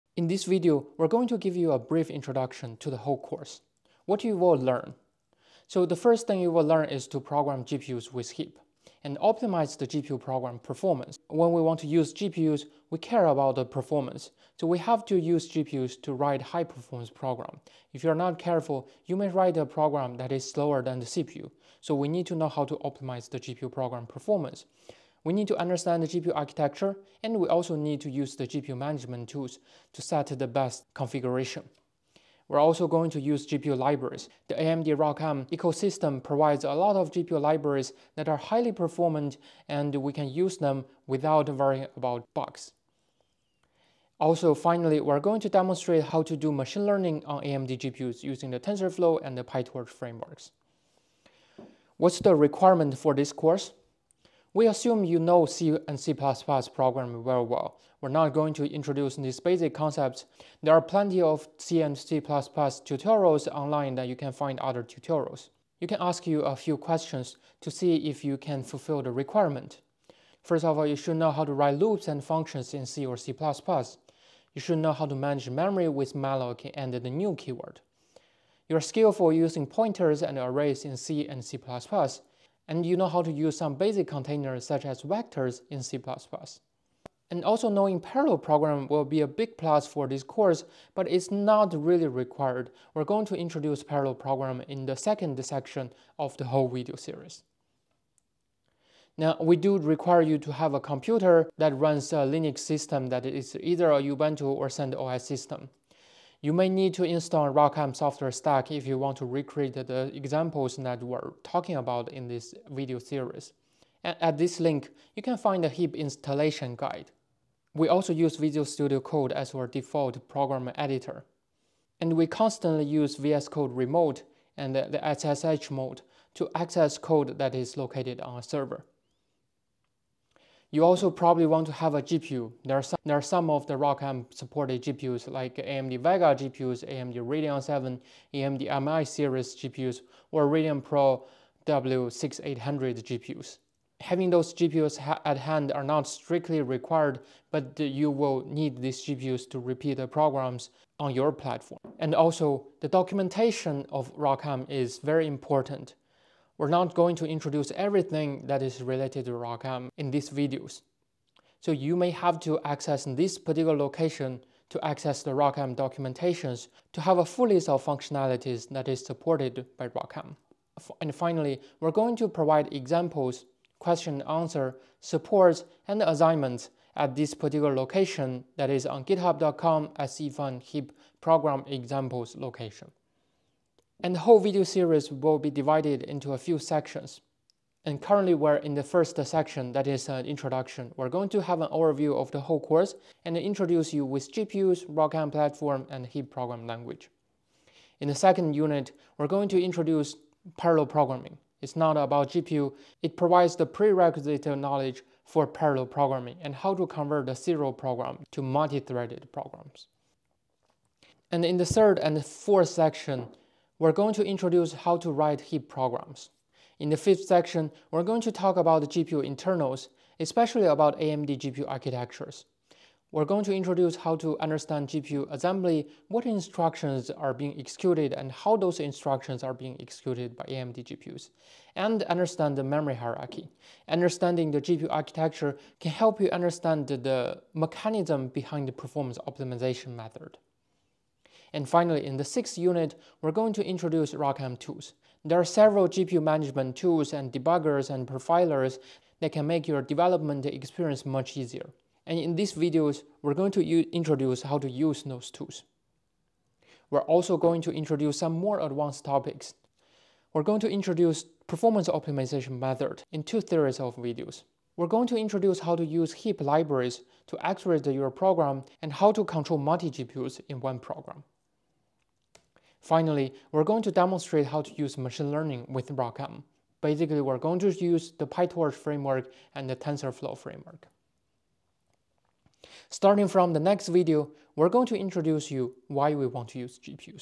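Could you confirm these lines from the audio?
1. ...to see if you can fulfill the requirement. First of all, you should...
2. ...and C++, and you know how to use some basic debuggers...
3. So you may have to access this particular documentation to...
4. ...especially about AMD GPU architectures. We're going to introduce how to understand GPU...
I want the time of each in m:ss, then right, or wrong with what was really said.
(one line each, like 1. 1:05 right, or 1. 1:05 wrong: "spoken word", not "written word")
1. 1:07 right
2. 1:21 wrong: "containers", not "debuggers"
3. 2:41 wrong: "location", not "documentation"
4. 3:40 right.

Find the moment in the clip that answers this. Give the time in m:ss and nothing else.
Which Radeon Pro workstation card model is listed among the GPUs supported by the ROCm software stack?
2:21.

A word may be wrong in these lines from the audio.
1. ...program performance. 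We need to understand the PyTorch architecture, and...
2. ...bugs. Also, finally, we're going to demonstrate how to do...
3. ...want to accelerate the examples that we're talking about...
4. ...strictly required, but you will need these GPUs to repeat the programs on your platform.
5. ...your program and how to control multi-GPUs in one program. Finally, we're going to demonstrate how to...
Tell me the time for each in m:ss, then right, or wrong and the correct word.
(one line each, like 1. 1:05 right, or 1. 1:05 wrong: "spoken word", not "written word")
1. 0:23 wrong: "GPU", not "PyTorch"
2. 0:42 right
3. 1:48 wrong: "recreate", not "accelerate"
4. 2:26 right
5. 4:27 right.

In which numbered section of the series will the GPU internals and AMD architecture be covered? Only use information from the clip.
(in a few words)
5th.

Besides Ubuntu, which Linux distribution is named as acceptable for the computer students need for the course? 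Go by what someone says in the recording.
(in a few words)
CentOS.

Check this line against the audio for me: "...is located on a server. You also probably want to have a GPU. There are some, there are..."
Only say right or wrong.
right.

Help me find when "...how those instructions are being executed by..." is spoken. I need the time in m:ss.
3:48.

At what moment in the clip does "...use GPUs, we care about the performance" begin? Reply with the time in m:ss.
0:11.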